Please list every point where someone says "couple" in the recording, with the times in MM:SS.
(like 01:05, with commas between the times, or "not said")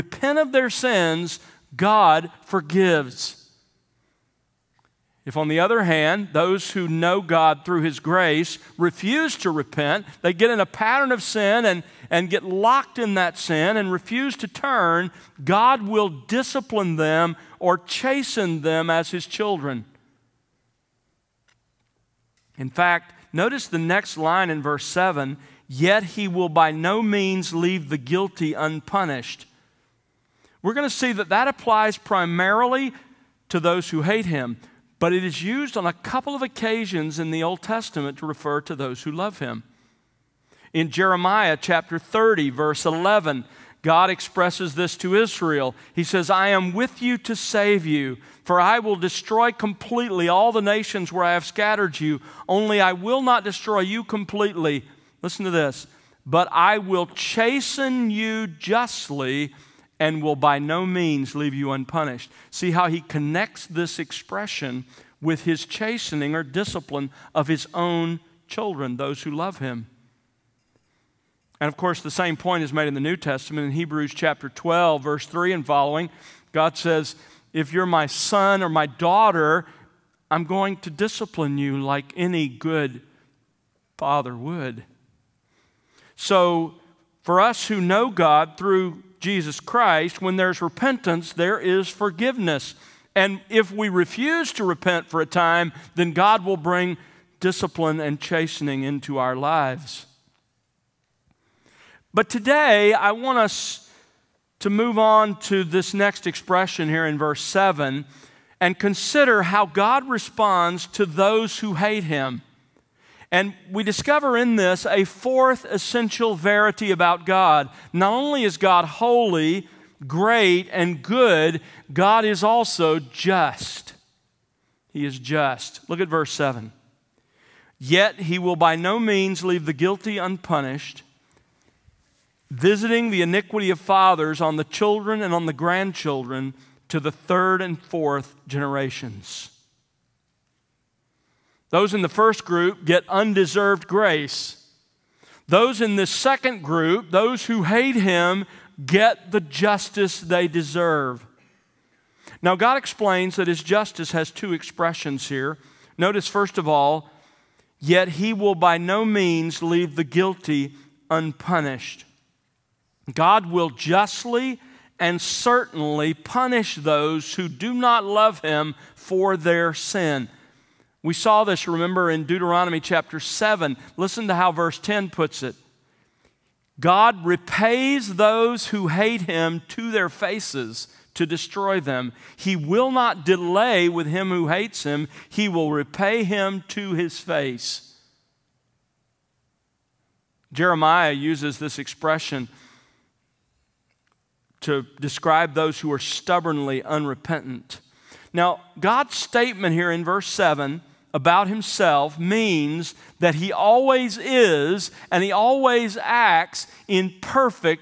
00:35.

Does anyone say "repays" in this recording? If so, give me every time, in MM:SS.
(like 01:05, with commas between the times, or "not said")
02:57, 03:05.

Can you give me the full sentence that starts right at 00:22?
In fact, notice the next line in verse 7 Yet He will by no means leave the guilty unpunished.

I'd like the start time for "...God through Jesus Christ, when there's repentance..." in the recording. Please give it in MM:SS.
01:28.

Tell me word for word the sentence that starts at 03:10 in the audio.
Jeremiah uses this expression to describe those who are stubbornly unrepentant.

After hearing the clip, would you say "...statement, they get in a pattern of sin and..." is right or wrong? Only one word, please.
wrong.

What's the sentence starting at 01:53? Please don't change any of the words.
And we discover in this a fourth essential verity about God.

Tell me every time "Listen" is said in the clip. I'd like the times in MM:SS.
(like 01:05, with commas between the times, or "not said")
00:55, 02:53.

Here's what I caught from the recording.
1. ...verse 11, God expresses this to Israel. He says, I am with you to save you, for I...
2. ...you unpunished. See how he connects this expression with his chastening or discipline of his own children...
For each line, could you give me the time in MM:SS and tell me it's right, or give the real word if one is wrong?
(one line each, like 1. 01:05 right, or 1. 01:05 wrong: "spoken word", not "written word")
1. 00:42 right
2. 01:01 right.